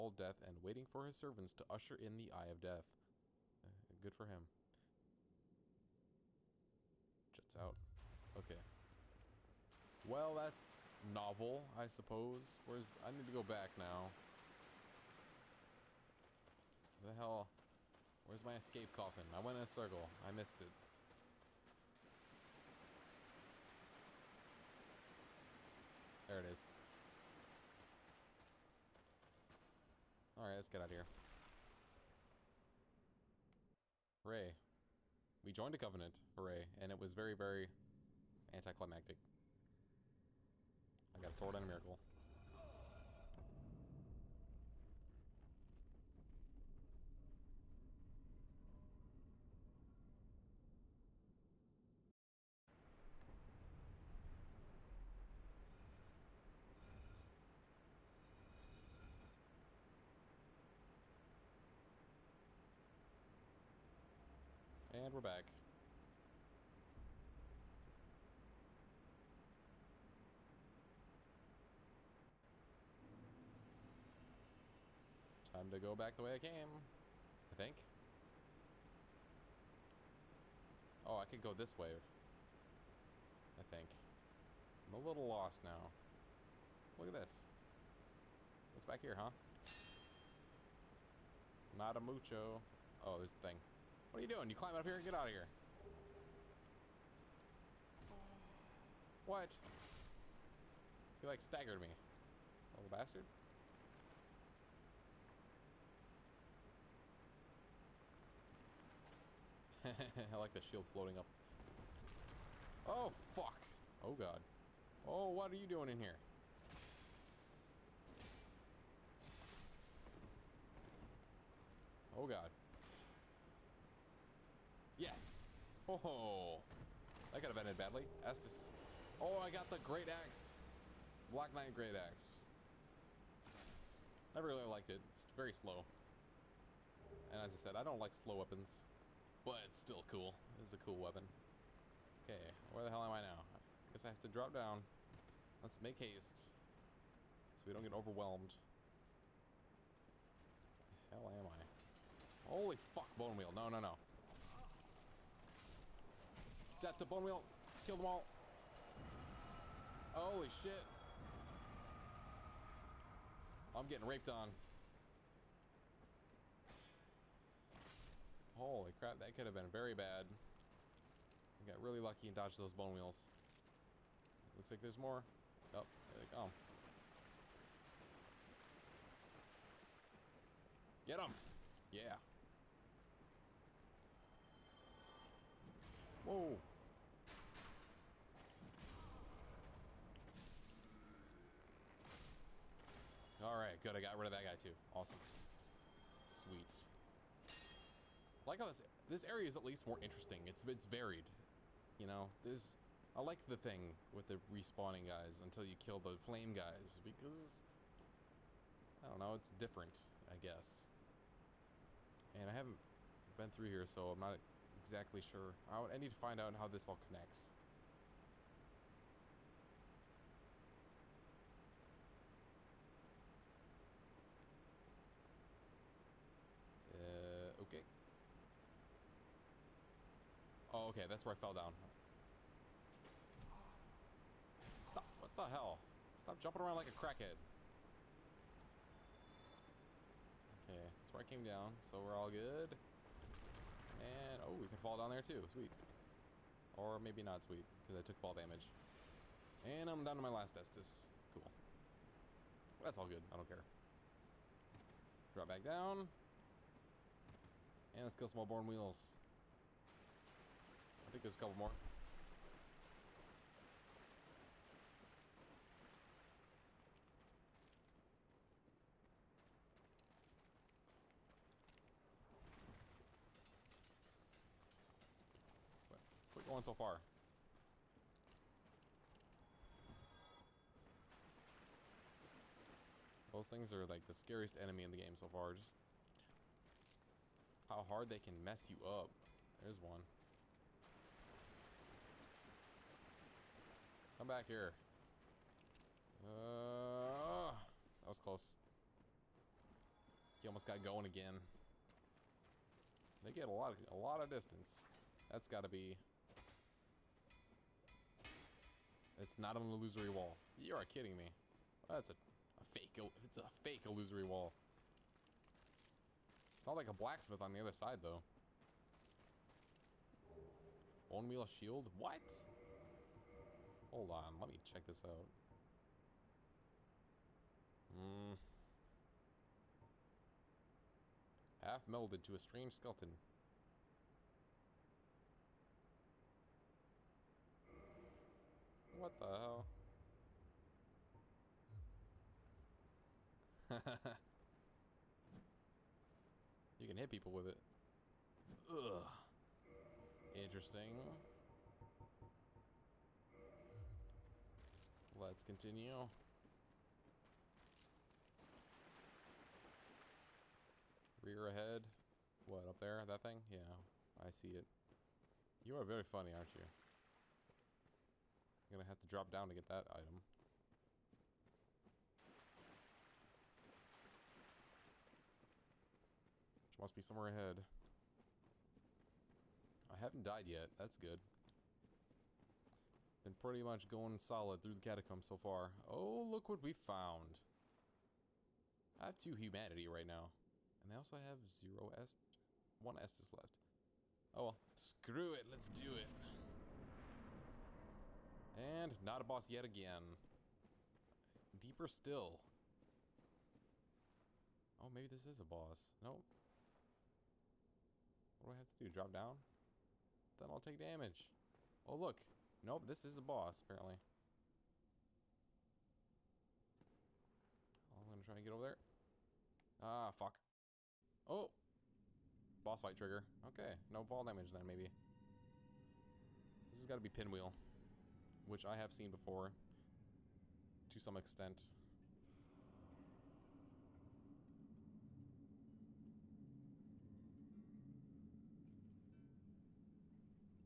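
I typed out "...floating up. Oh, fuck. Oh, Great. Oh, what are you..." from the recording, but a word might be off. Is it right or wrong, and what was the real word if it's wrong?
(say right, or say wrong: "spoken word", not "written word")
wrong: "God", not "Great".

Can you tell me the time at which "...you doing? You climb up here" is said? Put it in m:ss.
1:34.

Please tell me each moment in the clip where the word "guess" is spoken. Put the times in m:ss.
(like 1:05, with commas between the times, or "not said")
2:23, 3:30.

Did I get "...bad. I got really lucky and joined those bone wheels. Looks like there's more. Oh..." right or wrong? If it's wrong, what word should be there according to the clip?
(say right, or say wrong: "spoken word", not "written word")
wrong: "dodged", not "joined".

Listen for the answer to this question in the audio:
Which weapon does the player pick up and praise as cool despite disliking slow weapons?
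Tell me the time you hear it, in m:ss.
2:11.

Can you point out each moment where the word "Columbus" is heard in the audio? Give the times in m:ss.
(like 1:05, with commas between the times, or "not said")
not said.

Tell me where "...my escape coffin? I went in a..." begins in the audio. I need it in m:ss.
0:18.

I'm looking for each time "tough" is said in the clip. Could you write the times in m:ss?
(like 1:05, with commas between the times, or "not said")
not said.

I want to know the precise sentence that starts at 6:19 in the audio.
I haven't died yet, that's good.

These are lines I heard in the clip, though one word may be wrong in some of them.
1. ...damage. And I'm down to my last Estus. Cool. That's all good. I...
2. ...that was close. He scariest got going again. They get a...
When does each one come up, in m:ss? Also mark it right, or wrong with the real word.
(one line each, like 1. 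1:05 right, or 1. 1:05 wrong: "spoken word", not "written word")
1. 4:08 right
2. 4:57 wrong: "almost", not "scariest".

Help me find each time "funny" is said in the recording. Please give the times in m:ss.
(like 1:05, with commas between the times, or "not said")
6:06.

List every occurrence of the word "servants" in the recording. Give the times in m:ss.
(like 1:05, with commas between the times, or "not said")
0:01.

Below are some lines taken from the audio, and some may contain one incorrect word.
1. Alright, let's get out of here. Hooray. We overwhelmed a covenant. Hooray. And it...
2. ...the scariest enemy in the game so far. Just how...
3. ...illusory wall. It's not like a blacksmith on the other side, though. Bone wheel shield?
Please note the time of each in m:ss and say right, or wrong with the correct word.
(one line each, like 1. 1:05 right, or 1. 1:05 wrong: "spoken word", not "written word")
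1. 0:30 wrong: "joined", not "overwhelmed"
2. 4:44 right
3. 5:13 right.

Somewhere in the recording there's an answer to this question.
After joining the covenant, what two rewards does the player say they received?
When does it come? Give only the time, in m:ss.
0:41.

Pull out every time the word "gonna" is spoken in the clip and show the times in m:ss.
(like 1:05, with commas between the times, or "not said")
6:08, 6:58.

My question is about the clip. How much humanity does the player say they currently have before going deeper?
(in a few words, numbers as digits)
2.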